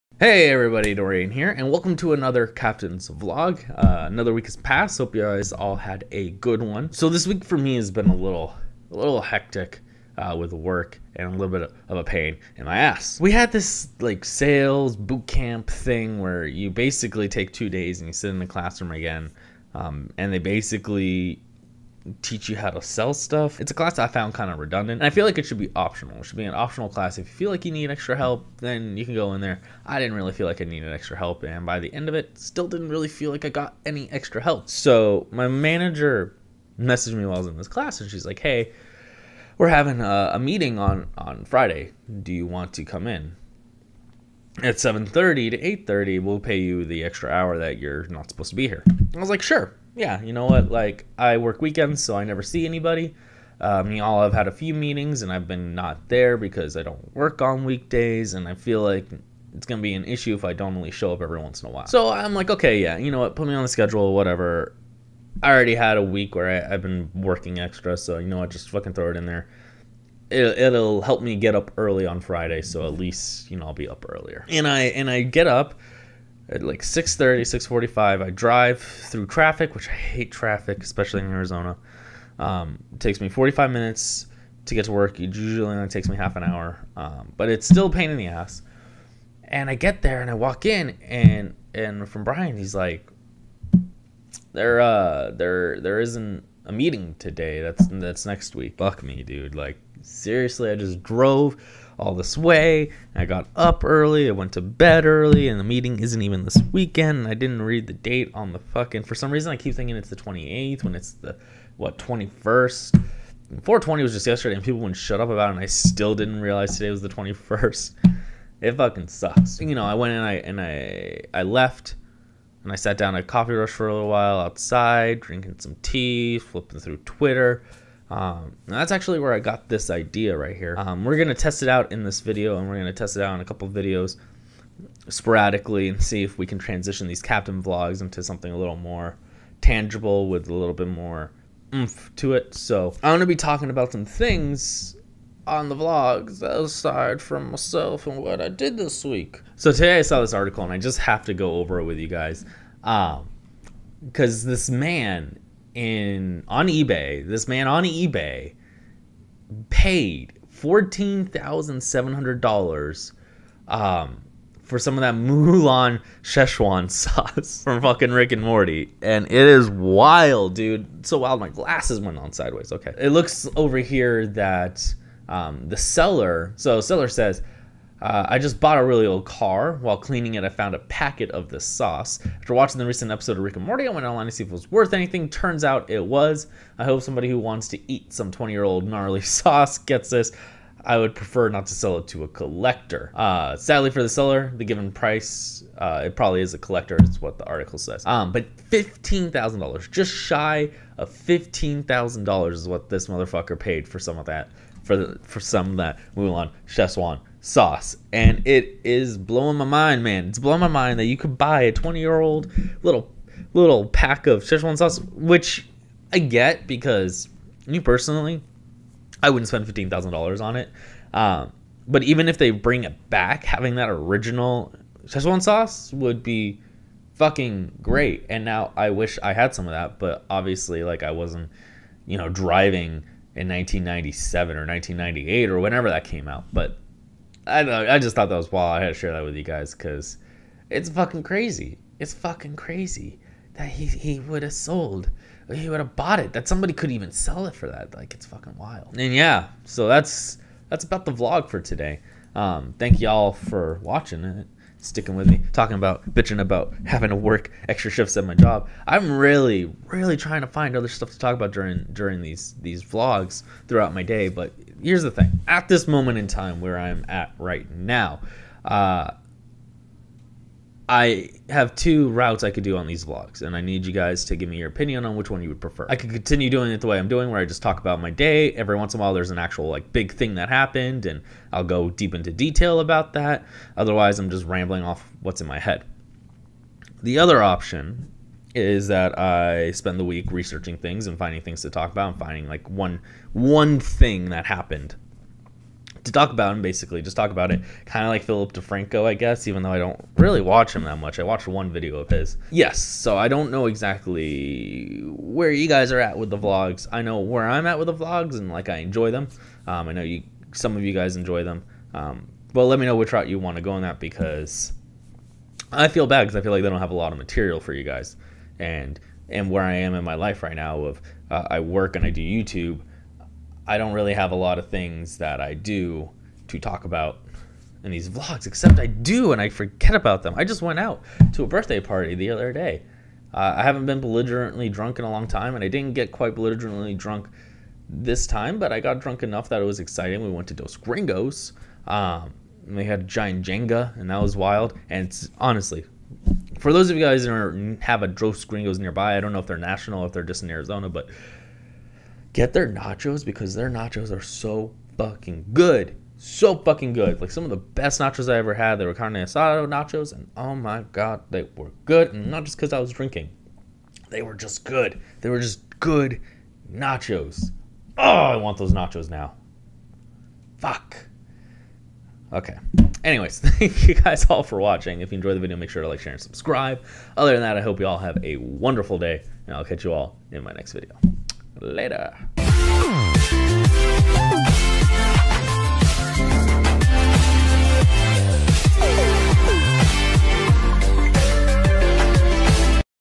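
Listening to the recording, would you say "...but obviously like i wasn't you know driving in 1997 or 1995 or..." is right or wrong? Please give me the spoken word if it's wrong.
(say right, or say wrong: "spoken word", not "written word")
wrong: "1998", not "1995".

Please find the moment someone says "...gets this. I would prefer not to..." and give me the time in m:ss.
3:09.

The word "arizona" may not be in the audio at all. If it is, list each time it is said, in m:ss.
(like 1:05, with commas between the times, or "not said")
1:21, 5:50.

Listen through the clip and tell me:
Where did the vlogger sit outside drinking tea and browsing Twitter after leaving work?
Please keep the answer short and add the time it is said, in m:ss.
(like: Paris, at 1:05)
Coffee Rush, at 2:03.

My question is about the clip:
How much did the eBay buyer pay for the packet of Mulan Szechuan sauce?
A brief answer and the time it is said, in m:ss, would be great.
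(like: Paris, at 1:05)
$14,700, at 2:40.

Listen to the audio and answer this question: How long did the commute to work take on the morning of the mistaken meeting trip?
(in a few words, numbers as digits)
45 minutes.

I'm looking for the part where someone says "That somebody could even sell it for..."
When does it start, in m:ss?
4:06.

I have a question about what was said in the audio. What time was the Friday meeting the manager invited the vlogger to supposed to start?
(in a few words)
7:30.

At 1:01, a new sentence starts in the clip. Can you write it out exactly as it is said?
So I'm like, okay, yeah, you know what?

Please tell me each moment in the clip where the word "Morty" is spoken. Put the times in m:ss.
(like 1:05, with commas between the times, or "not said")
2:48, 3:03.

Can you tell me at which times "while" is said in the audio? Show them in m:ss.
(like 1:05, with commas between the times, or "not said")
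0:37, 1:01, 2:04, 2:59, 4:39.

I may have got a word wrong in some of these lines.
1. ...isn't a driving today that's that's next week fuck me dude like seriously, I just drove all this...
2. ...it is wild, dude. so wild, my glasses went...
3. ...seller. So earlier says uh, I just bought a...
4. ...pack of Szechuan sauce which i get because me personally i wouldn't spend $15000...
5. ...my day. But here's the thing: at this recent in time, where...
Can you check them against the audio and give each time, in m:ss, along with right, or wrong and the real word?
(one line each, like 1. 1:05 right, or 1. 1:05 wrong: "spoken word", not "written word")
1. 1:35 wrong: "meeting", not "driving"
2. 2:49 right
3. 2:55 wrong: "seller", not "earlier"
4. 3:33 right
5. 4:23 wrong: "moment", not "recent".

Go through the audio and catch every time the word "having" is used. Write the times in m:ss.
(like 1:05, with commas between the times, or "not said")
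0:39, 3:43, 4:16.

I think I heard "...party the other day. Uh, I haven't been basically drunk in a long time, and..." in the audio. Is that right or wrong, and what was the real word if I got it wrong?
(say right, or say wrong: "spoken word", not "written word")
wrong: "belligerently", not "basically".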